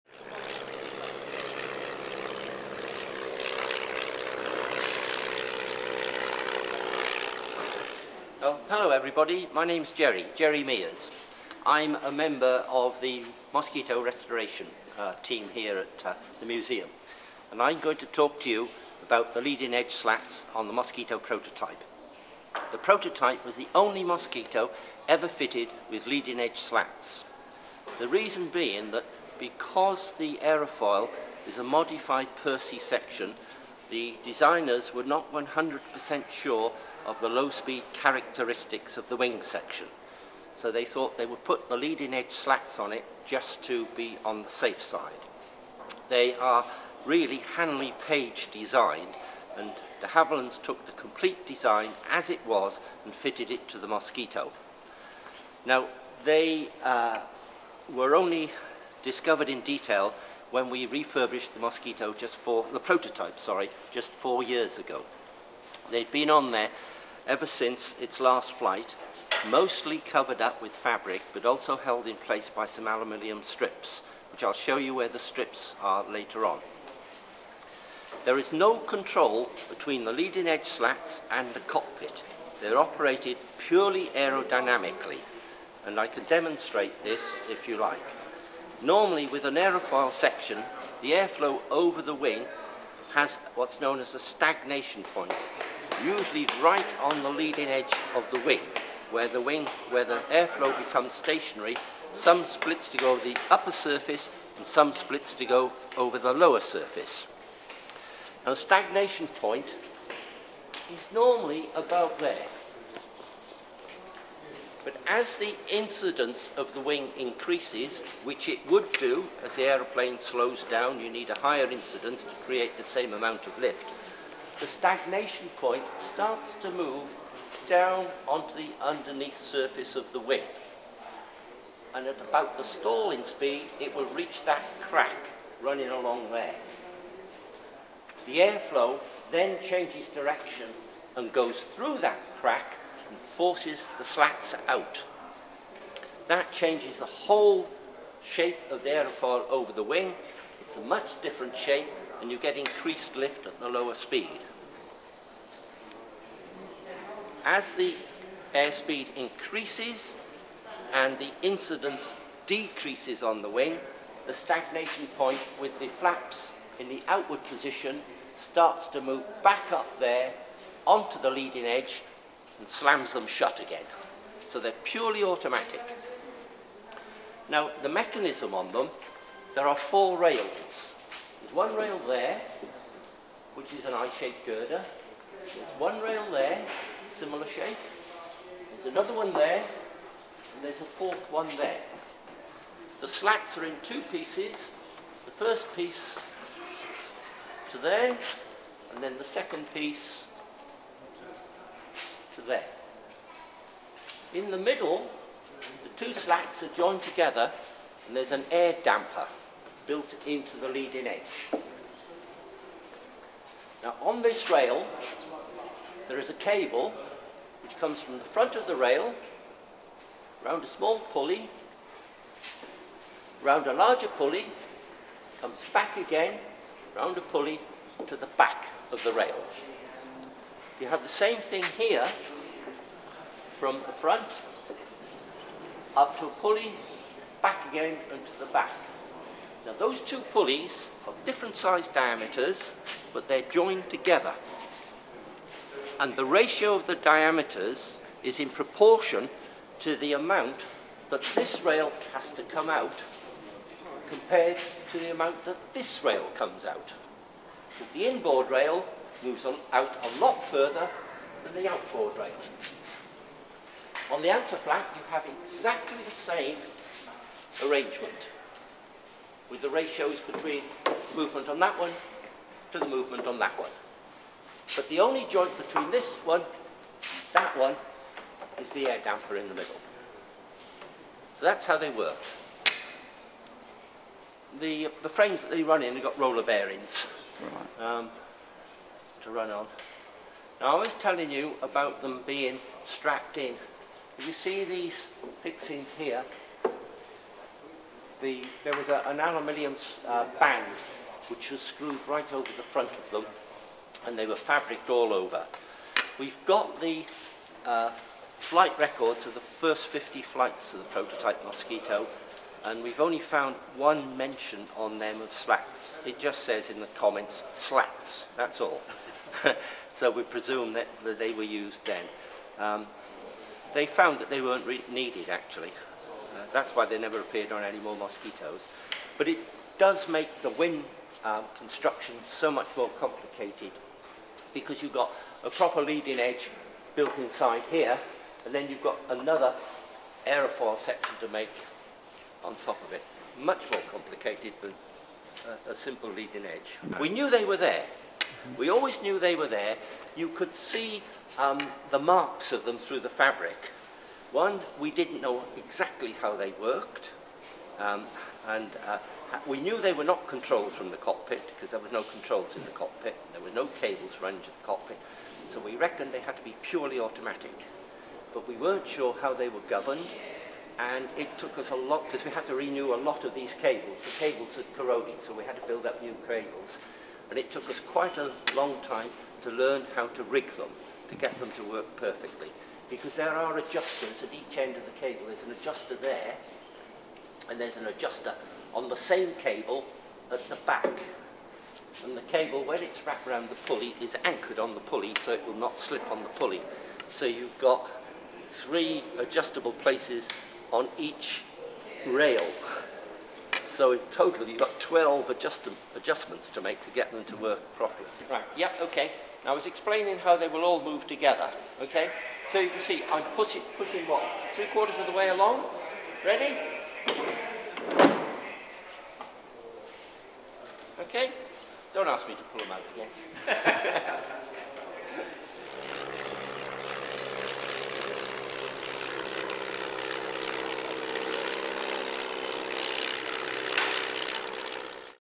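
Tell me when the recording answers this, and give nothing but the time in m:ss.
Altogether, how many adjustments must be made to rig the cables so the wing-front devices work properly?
6:44.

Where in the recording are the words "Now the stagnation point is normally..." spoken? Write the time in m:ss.
1:48.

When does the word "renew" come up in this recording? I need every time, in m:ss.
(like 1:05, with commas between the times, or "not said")
6:12.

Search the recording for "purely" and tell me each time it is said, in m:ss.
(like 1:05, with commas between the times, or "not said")
1:23, 2:54, 6:06.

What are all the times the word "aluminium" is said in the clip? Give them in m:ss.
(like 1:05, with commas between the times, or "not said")
1:12, 4:59.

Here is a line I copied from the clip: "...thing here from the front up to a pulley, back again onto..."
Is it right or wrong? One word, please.
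right.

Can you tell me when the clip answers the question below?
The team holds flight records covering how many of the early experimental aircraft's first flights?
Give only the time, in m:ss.
5:09.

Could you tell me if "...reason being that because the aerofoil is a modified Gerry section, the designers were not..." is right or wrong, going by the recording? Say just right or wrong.
wrong.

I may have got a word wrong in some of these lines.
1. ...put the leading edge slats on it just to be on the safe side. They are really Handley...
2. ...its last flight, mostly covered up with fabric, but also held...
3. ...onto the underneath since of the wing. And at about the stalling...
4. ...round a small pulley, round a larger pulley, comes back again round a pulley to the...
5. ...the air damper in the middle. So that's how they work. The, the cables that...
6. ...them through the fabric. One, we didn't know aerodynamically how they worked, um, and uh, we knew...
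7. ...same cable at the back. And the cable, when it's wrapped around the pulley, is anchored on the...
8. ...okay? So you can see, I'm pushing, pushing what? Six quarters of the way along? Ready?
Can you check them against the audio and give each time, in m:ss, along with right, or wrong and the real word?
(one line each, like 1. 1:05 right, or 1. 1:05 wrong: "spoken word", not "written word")
1. 0:41 right
2. 1:07 right
3. 2:08 wrong: "surface", not "since"
4. 3:40 right
5. 4:38 wrong: "frames", not "cables"
6. 5:52 wrong: "exactly", not "aerodynamically"
7. 6:28 right
8. 6:51 wrong: "Three", not "Six".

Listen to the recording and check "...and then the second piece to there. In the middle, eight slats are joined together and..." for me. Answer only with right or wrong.
wrong.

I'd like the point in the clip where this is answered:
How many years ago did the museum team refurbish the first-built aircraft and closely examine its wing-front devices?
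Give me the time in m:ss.
1:04.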